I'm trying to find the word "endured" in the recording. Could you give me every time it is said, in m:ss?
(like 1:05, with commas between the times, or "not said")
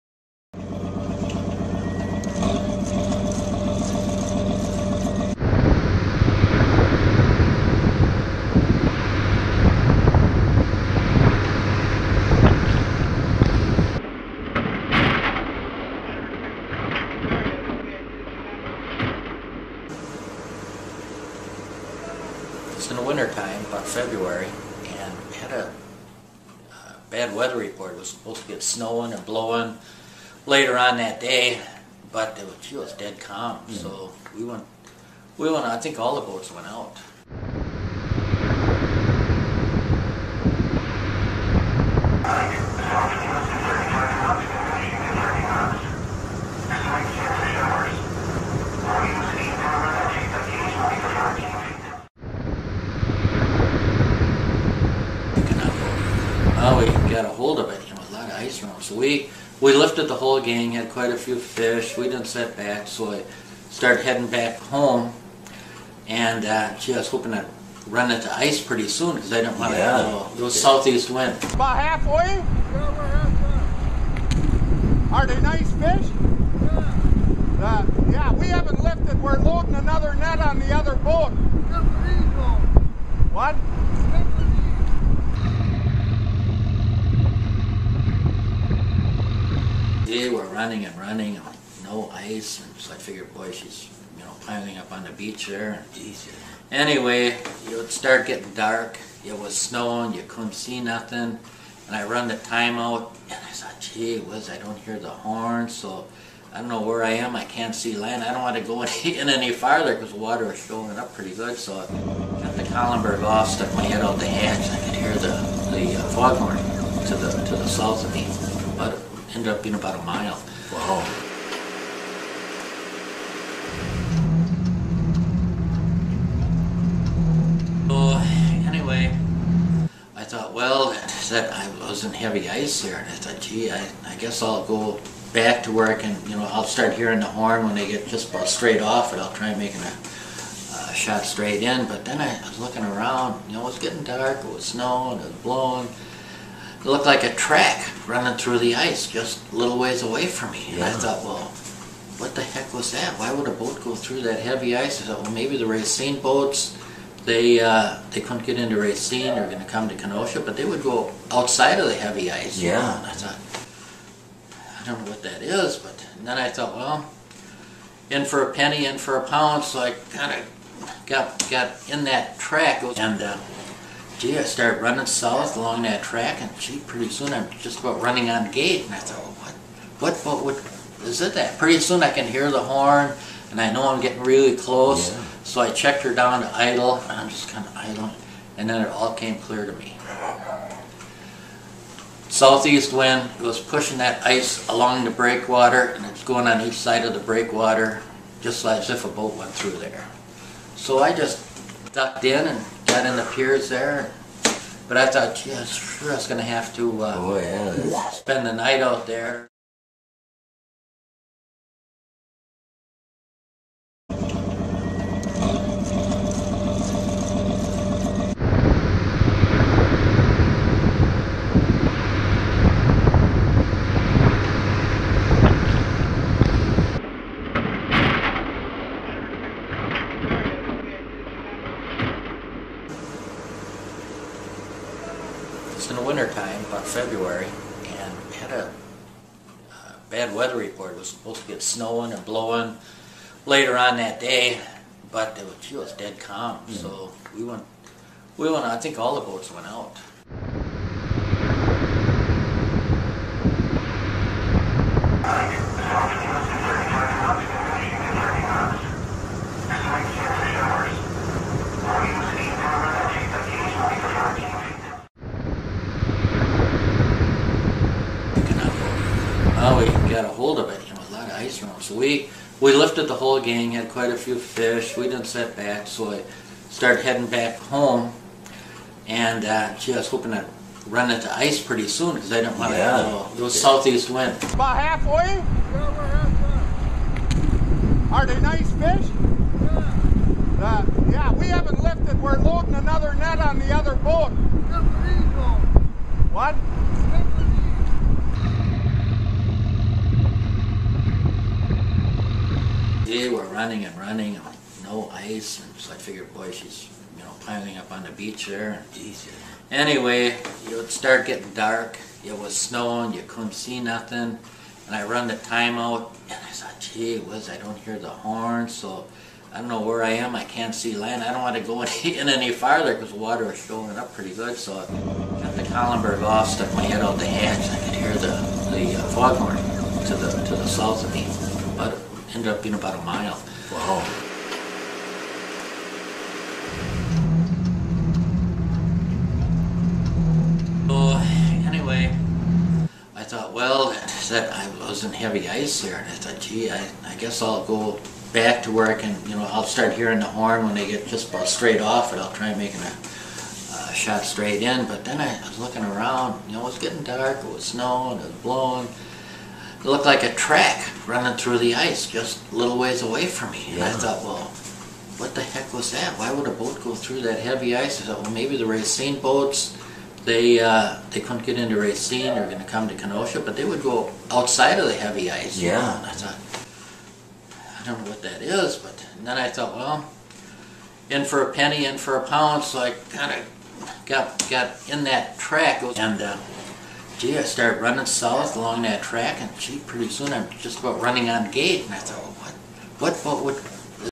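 not said.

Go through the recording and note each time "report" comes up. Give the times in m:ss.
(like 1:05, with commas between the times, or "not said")
0:27, 4:00.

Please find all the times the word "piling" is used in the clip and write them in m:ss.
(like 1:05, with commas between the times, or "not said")
1:34, 5:07.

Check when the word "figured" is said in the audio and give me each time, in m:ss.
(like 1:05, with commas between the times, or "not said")
1:32, 5:05.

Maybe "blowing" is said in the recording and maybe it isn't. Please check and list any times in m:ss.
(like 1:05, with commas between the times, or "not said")
0:29, 2:25, 4:02, 5:58.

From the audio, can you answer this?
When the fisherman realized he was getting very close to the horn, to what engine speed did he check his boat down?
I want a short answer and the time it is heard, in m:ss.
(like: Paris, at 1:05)
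Idle, at 3:06.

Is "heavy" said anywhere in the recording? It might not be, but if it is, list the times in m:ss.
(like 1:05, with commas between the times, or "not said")
2:12, 2:34, 2:41, 5:45, 6:07, 6:14.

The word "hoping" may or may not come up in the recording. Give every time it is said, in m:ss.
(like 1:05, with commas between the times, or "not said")
1:07, 4:40.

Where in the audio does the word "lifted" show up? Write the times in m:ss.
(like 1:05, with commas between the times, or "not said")
0:59, 1:18, 4:32, 4:51.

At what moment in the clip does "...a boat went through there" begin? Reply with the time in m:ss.
3:19.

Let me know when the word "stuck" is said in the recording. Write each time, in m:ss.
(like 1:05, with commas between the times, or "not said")
1:53, 5:26.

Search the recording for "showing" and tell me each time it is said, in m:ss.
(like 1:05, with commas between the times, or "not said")
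1:50, 5:23.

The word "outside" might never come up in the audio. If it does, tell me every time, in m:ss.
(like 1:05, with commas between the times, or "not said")
2:41, 6:14.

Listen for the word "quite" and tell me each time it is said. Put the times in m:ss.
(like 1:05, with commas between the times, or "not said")
1:00, 4:33.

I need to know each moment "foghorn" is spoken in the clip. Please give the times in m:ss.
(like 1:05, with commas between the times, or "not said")
1:56, 5:29.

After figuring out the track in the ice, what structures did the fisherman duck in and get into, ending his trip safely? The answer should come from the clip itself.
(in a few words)
The piers.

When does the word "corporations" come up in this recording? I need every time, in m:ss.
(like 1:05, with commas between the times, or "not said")
not said.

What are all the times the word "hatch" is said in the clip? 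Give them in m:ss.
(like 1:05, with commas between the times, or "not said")
1:54, 5:27.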